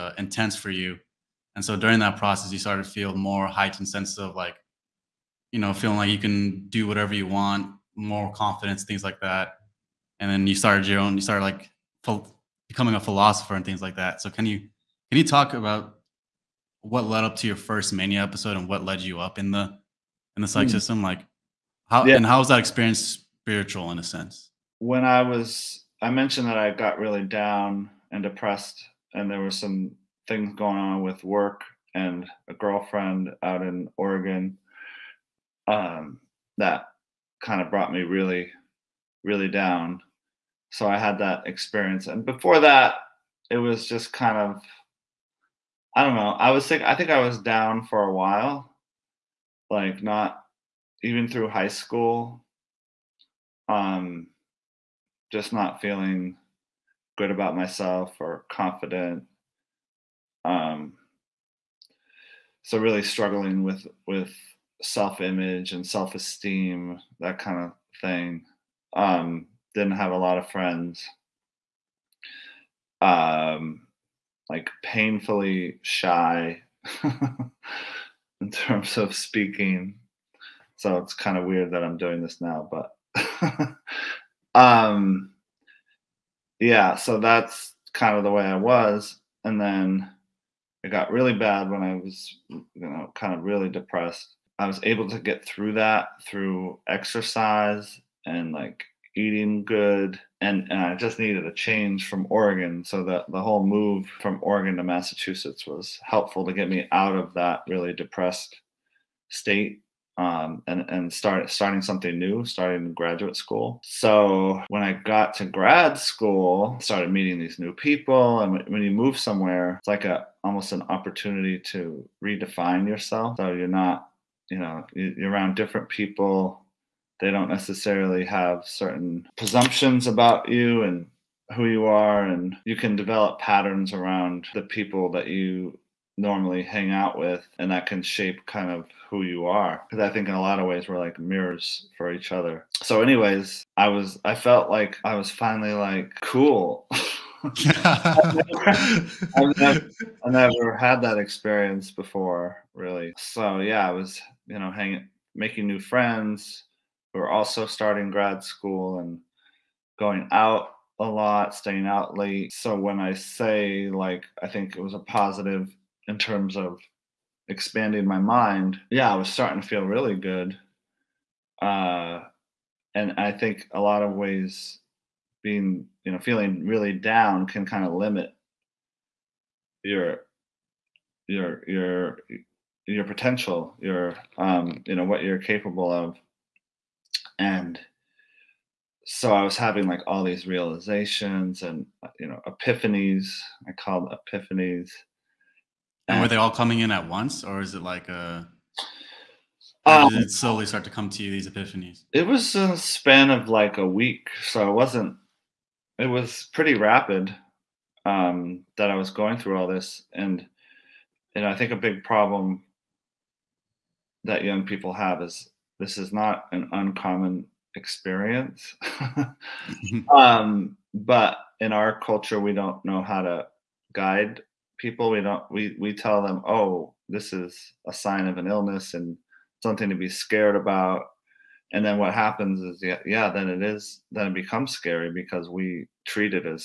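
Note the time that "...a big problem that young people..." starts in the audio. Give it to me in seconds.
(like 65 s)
211 s.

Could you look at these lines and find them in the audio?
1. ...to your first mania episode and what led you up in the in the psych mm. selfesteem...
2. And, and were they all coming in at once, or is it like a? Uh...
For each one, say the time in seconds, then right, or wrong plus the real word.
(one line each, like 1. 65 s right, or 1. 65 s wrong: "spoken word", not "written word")
1. 17 s wrong: "system", not "selfesteem"
2. 196 s right.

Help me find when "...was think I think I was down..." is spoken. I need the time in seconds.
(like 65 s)
46 s.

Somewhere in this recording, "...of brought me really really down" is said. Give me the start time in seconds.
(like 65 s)
37 s.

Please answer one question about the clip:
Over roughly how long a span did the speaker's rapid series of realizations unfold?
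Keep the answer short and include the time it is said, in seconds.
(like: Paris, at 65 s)
a week, at 203 s.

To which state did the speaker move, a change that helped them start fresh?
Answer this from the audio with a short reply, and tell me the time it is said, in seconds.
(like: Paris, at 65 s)
Massachusetts, at 104 s.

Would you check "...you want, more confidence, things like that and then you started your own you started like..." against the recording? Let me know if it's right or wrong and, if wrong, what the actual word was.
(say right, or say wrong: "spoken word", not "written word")
right.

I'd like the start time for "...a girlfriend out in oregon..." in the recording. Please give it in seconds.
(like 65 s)
32 s.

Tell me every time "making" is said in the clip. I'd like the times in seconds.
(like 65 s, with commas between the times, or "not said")
155 s.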